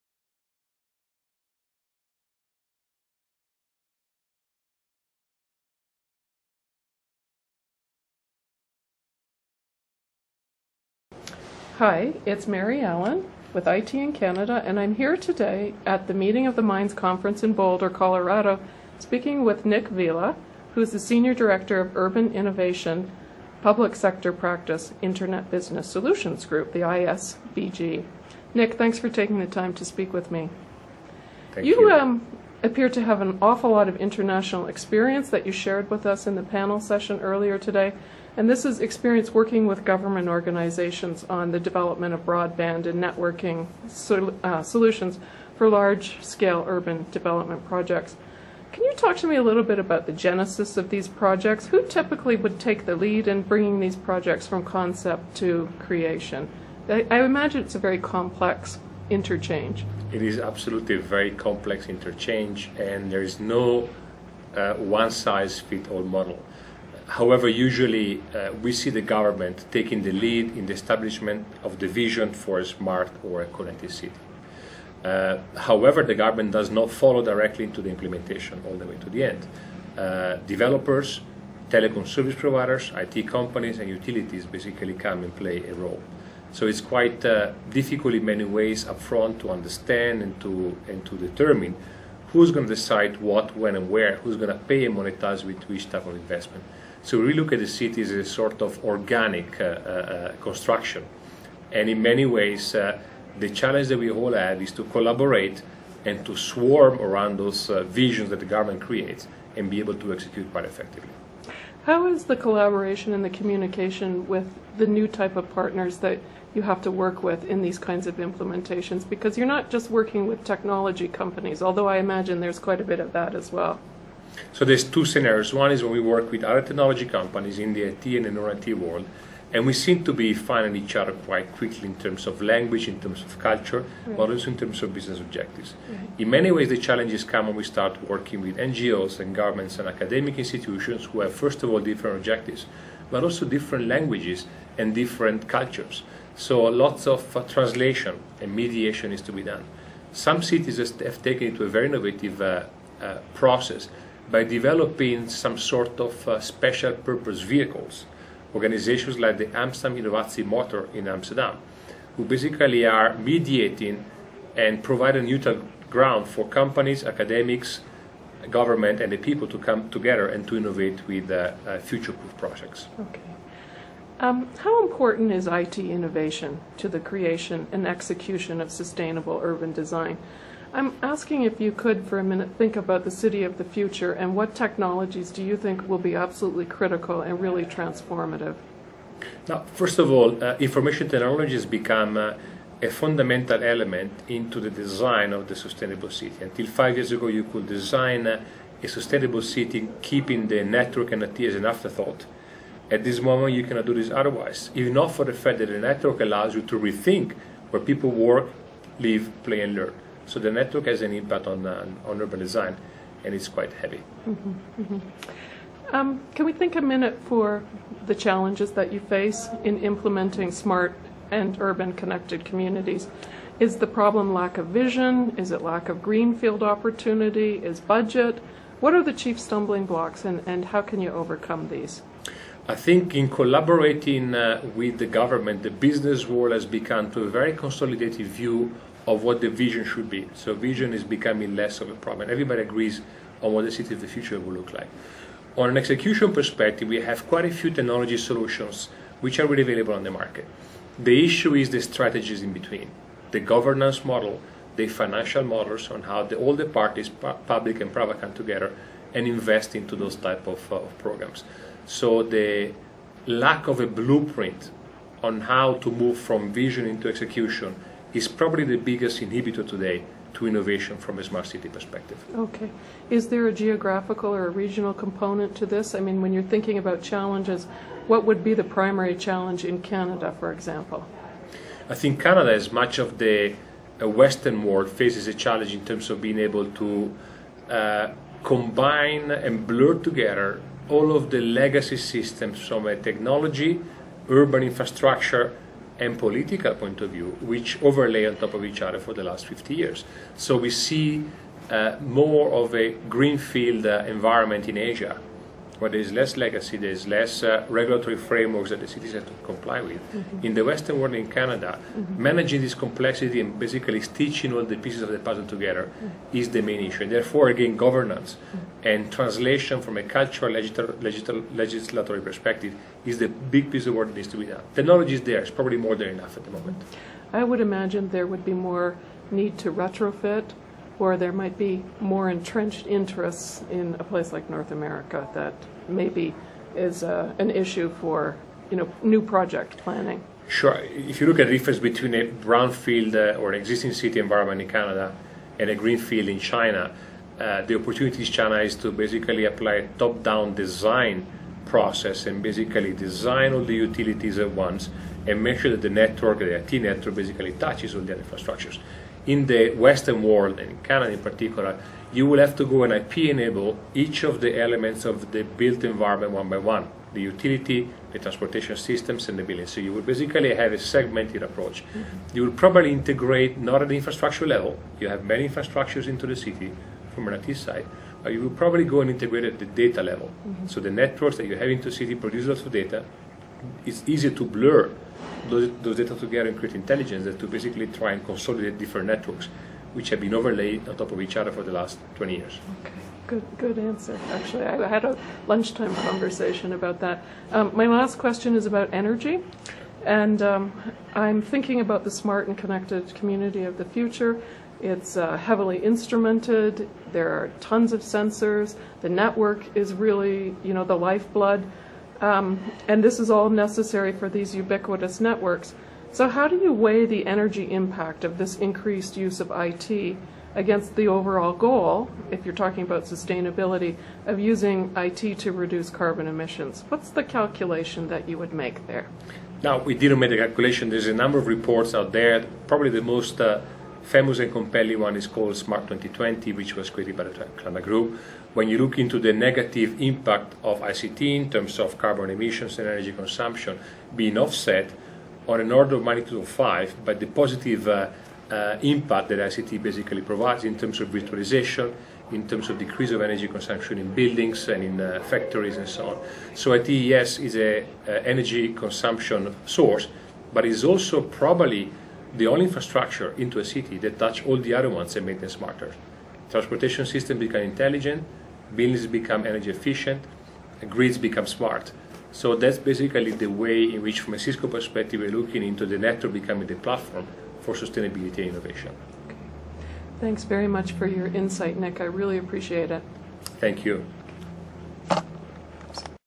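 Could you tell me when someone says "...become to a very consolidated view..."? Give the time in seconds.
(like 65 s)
236 s.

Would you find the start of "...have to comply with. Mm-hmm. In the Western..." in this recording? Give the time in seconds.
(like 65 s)
309 s.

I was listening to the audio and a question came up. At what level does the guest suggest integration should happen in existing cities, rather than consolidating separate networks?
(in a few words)
data level.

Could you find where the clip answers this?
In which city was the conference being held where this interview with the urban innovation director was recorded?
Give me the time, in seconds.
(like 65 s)
17 s.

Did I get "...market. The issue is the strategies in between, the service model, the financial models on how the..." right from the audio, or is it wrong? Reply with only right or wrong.
wrong.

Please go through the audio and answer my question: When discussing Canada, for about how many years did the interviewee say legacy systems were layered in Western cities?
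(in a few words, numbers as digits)
50.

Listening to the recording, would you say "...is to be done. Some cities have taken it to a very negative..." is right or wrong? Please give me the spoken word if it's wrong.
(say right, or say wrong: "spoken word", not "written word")
wrong: "innovative", not "negative".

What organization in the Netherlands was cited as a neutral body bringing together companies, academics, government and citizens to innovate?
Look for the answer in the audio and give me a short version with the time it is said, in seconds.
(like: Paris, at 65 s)
Amsterdam Innovatie Motor, at 159 s.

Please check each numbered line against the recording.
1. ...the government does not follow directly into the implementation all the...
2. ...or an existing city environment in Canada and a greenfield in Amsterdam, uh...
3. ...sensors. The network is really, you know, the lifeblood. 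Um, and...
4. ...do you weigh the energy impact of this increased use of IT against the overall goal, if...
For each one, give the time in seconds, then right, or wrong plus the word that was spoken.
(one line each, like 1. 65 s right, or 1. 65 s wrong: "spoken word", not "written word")
1. 76 s right
2. 343 s wrong: "China", not "Amsterdam"
3. 407 s right
4. 416 s right.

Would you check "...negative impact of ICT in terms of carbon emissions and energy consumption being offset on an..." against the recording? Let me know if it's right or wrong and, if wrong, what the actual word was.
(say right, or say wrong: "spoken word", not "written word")
right.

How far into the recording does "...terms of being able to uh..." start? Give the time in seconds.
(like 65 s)
285 s.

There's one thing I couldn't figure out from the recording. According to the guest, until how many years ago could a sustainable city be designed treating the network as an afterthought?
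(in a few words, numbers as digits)
5.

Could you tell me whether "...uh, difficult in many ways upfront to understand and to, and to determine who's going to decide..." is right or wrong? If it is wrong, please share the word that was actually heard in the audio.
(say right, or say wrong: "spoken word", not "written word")
right.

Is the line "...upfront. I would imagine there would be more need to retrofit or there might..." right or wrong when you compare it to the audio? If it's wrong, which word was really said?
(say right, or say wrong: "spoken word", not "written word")
wrong: "moment", not "upfront".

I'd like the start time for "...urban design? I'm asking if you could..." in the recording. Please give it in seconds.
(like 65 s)
179 s.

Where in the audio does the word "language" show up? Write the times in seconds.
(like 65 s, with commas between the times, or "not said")
132 s, 143 s.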